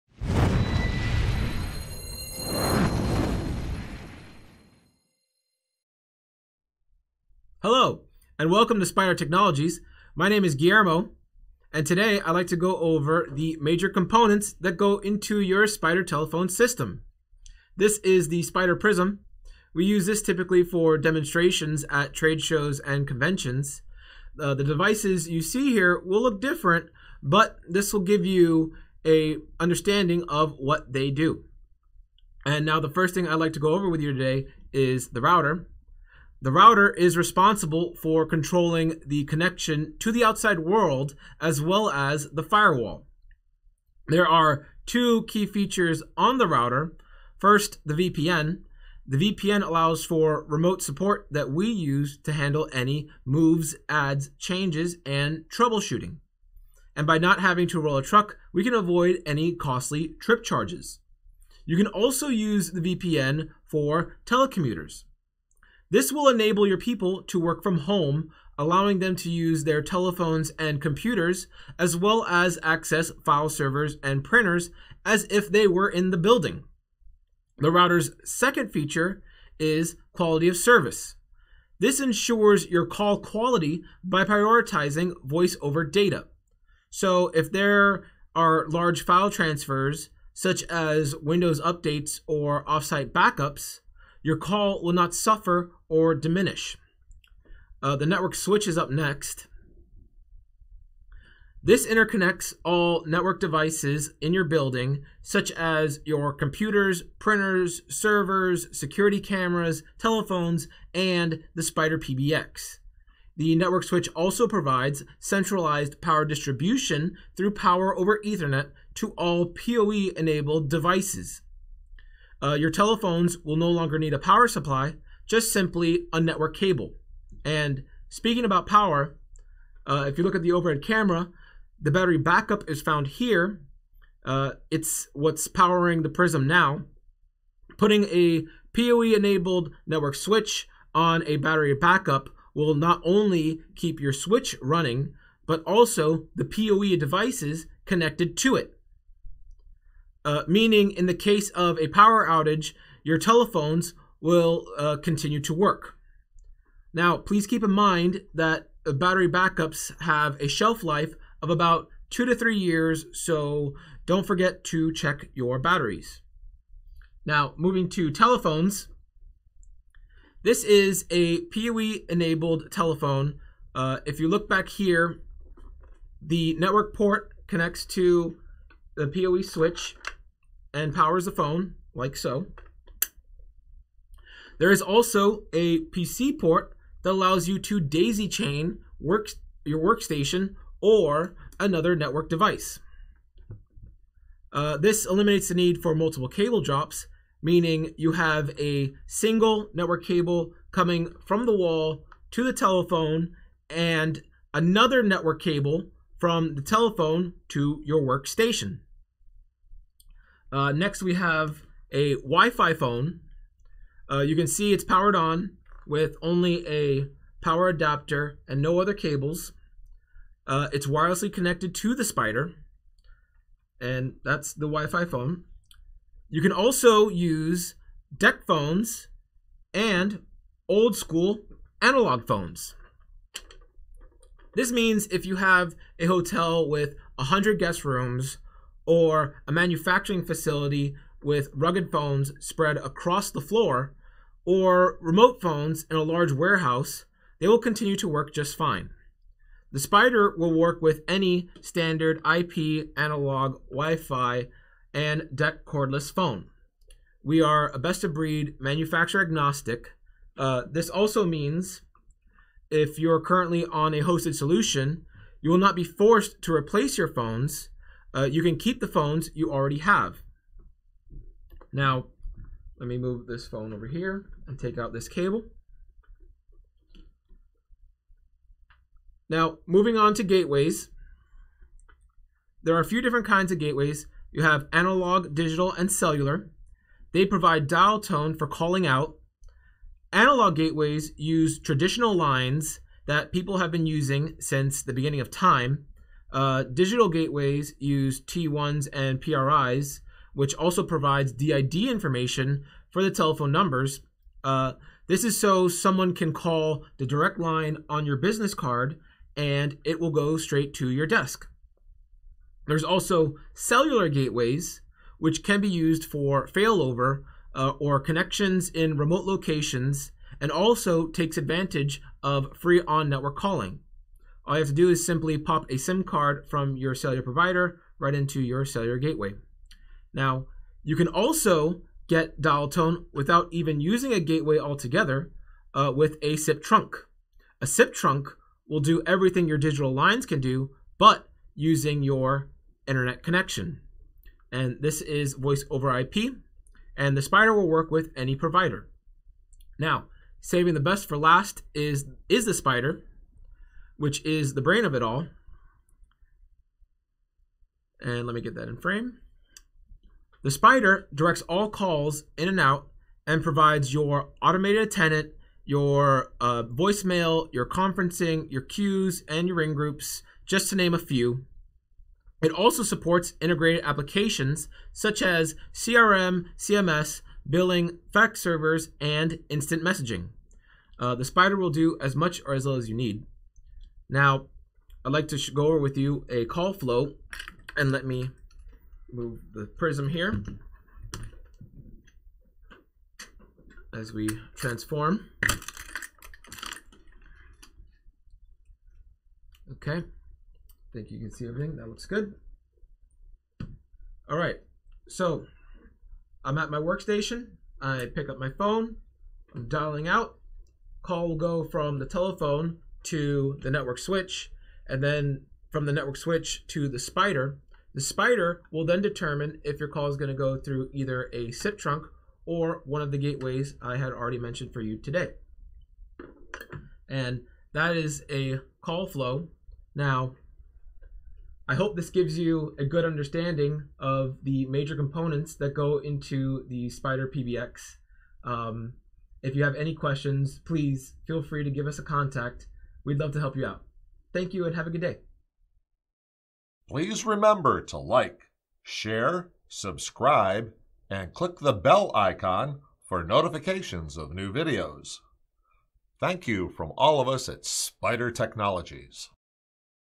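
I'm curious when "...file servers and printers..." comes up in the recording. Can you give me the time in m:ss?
1:13.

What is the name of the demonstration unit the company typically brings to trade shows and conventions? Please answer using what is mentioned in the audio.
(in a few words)
Spydur Prism.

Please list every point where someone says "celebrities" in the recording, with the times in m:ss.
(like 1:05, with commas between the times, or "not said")
not said.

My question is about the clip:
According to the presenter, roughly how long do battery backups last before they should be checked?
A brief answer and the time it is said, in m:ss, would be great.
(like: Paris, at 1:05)
2 to 3 years, at 2:42.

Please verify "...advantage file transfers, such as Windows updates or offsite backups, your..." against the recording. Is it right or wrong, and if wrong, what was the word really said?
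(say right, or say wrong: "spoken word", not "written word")
wrong: "large", not "advantage".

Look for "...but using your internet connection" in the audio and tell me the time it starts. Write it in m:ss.
5:40.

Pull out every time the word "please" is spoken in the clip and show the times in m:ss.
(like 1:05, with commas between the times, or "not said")
2:37, 7:20, 7:26.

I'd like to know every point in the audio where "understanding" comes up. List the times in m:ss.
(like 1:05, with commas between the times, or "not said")
0:29, 7:13.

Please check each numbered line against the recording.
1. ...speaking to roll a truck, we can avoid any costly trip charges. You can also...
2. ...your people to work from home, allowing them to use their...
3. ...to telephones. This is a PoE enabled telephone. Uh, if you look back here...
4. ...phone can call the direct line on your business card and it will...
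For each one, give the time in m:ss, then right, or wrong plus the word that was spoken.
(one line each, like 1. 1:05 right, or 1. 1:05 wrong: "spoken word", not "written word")
1. 0:57 wrong: "having", not "speaking"
2. 1:06 right
3. 2:47 right
4. 5:05 wrong: "someone", not "phone".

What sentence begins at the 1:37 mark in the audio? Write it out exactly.
Uh, the network switch is up next.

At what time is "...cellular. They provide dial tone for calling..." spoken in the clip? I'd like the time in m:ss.
4:45.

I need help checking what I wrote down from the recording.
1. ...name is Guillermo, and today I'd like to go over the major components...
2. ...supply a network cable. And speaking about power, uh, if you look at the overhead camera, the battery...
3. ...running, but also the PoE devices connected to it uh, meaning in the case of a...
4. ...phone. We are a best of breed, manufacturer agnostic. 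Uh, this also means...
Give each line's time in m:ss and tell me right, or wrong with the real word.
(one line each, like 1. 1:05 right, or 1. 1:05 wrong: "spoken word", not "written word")
1. 0:10 right
2. 2:05 wrong: "simply", not "supply"
3. 2:24 right
4. 4:16 right.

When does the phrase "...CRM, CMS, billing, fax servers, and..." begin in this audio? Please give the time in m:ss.
6:15.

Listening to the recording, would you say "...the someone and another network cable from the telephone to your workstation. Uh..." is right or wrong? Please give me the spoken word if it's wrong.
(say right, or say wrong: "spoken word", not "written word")
wrong: "telephone", not "someone".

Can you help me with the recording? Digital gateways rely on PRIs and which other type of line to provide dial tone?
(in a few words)
T1s.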